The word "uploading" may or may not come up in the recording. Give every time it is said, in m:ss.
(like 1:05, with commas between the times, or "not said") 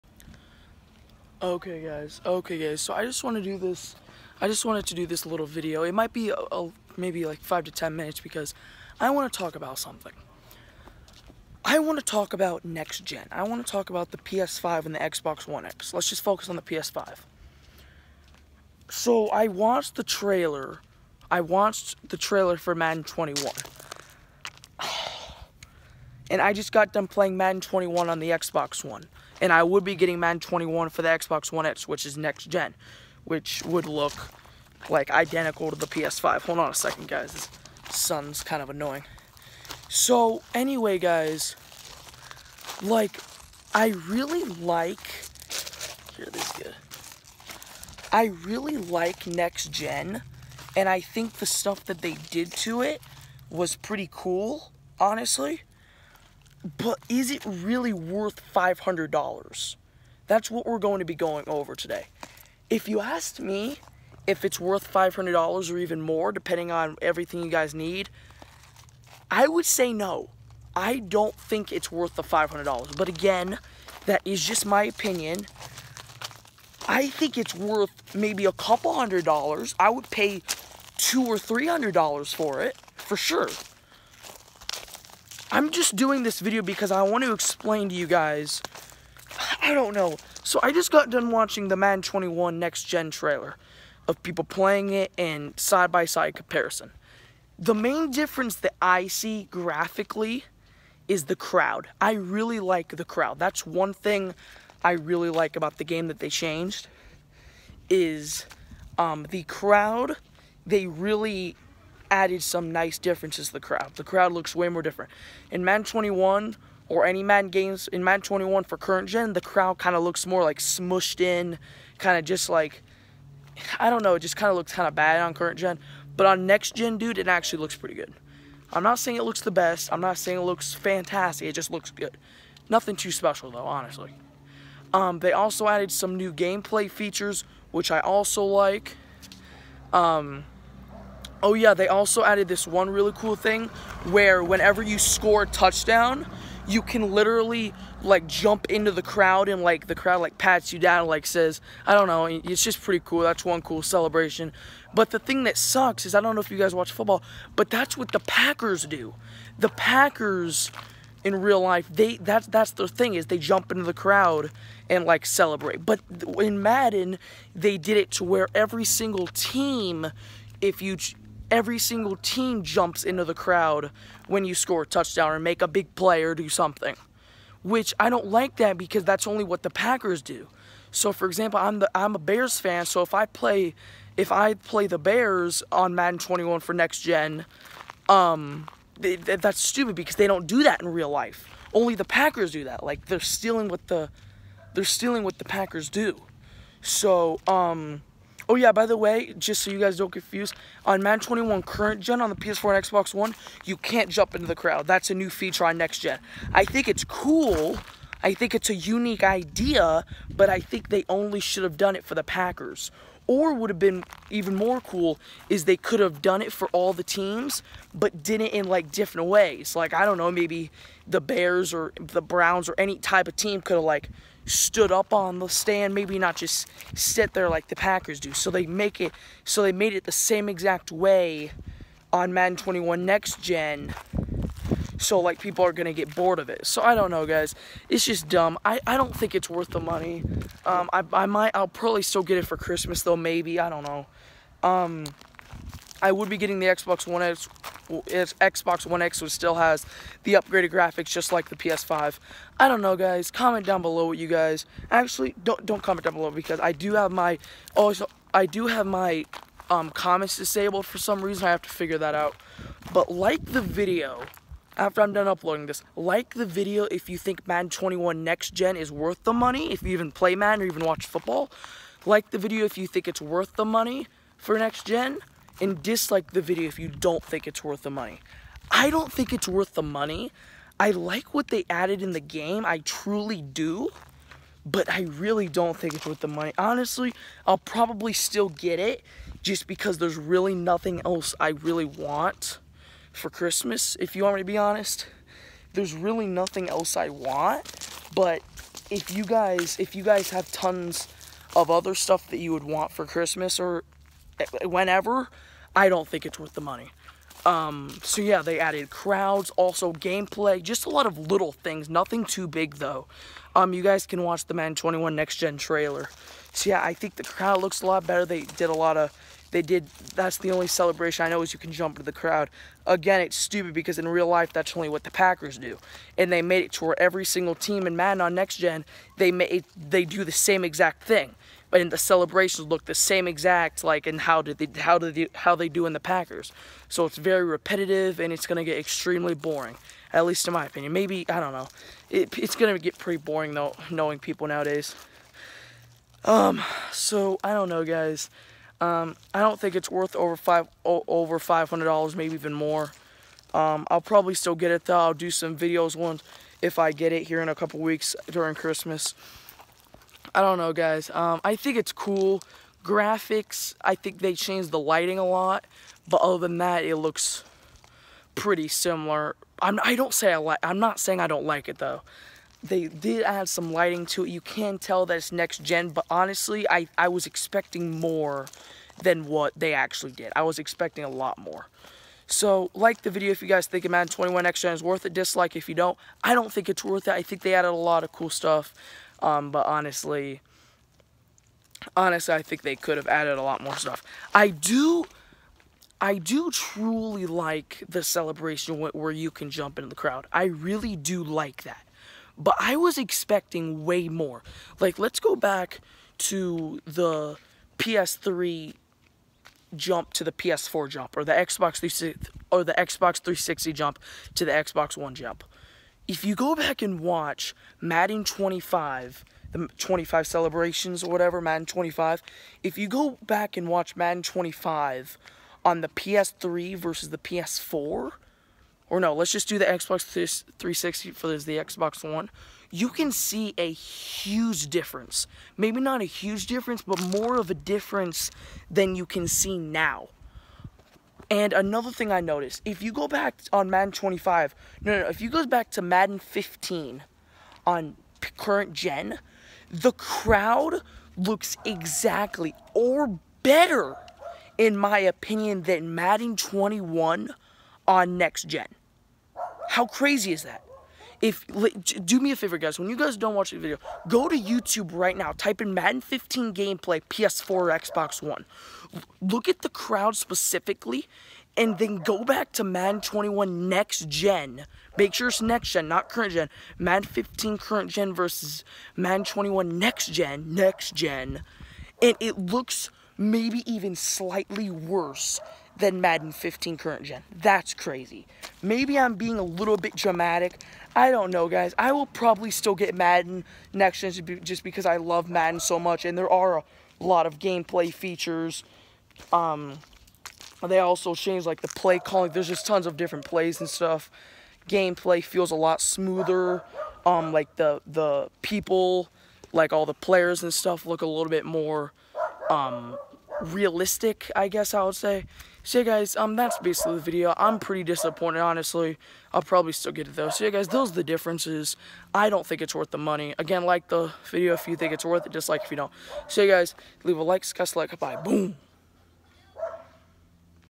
4:25.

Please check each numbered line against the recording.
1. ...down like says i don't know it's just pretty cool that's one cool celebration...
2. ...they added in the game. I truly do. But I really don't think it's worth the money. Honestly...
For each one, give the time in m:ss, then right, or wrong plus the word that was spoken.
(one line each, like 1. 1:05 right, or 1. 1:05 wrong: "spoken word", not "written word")
1. 2:30 right
2. 4:41 right.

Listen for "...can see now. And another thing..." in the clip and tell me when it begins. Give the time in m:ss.
7:19.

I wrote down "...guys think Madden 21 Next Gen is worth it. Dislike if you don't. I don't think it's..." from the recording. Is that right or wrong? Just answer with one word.
right.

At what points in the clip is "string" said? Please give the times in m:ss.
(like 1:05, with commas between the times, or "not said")
not said.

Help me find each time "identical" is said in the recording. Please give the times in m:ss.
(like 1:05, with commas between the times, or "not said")
0:35.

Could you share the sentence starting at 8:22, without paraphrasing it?
There's just tons of different plays and stuff.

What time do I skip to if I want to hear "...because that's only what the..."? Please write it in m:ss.
2:58.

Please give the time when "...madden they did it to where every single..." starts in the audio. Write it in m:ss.
2:46.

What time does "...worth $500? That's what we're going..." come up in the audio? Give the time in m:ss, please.
0:57.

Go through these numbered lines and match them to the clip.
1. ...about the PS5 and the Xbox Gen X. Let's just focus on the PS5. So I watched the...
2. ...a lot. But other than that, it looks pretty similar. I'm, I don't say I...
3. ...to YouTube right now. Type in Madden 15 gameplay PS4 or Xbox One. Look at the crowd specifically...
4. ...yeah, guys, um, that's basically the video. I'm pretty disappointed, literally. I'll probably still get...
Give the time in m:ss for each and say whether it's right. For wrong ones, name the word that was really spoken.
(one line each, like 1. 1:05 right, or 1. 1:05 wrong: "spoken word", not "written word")
1. 0:13 wrong: "One", not "Gen"
2. 6:05 right
3. 7:44 right
4. 8:35 wrong: "honestly", not "literally".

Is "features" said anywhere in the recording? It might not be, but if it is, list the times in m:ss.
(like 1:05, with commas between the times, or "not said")
2:16, 3:25, 8:17.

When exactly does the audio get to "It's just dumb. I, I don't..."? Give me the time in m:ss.
3:57.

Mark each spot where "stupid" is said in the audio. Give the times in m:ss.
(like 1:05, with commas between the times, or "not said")
3:09, 5:23.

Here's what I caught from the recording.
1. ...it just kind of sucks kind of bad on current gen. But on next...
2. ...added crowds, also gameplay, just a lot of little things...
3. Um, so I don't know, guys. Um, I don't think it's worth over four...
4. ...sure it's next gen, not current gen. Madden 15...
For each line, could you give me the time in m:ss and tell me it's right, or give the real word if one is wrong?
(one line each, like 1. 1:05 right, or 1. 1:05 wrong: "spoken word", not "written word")
1. 2:04 wrong: "looks", not "sucks"
2. 5:08 right
3. 5:46 wrong: "five", not "four"
4. 7:55 right.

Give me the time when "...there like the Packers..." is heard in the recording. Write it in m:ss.
3:47.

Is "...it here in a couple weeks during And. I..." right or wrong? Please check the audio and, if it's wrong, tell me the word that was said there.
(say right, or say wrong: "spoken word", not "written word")
wrong: "Christmas", not "And".